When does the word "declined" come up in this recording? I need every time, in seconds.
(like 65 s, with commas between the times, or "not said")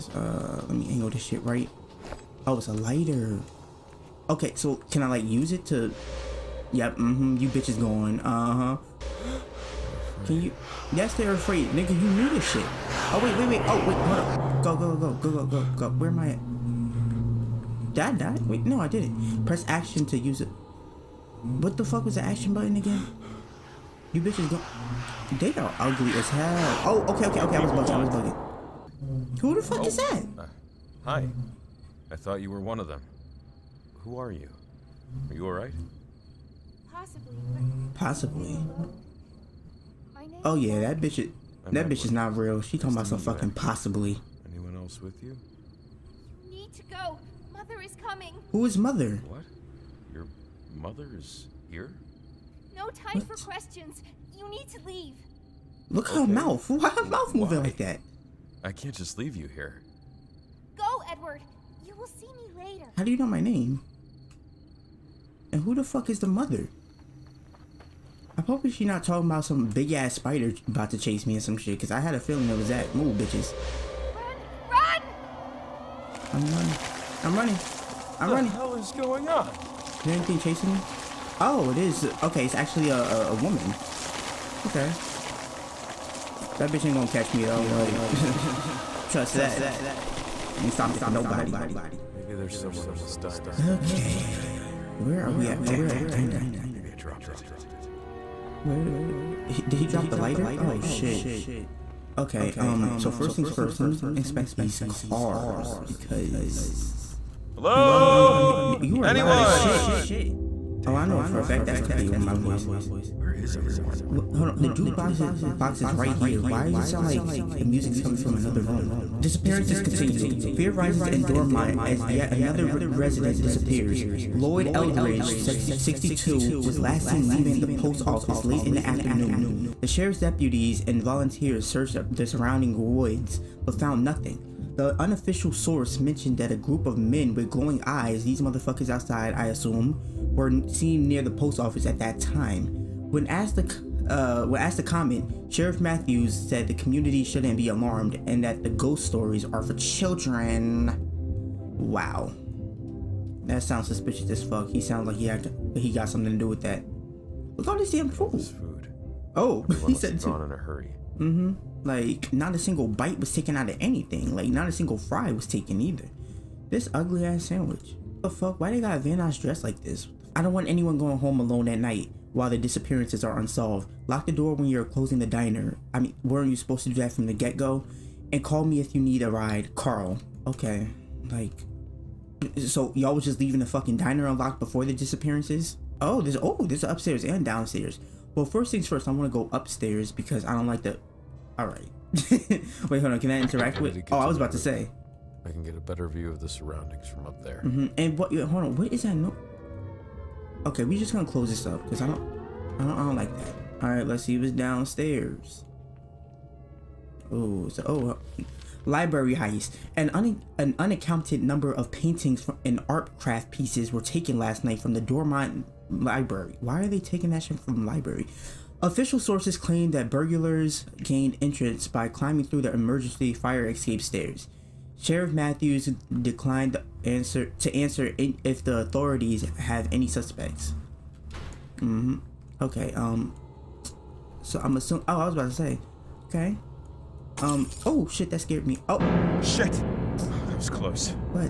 225 s.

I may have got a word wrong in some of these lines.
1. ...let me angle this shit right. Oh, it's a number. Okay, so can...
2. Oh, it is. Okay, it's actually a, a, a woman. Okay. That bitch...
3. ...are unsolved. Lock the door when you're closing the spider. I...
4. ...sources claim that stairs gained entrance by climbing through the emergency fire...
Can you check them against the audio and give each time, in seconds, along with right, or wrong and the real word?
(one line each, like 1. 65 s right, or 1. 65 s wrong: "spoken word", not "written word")
1. 0 s wrong: "lighter", not "number"
2. 81 s right
3. 173 s wrong: "diner", not "spider"
4. 219 s wrong: "burglars", not "stairs".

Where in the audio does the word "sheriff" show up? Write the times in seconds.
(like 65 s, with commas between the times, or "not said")
129 s, 145 s, 224 s.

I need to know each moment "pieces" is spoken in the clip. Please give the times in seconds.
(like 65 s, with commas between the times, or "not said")
213 s.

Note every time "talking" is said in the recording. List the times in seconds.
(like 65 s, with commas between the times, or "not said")
42 s, 69 s.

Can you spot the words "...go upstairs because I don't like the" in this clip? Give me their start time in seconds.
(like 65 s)
189 s.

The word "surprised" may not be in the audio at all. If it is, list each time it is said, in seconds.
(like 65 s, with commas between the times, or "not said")
not said.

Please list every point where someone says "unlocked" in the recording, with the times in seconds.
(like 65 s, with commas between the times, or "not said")
184 s.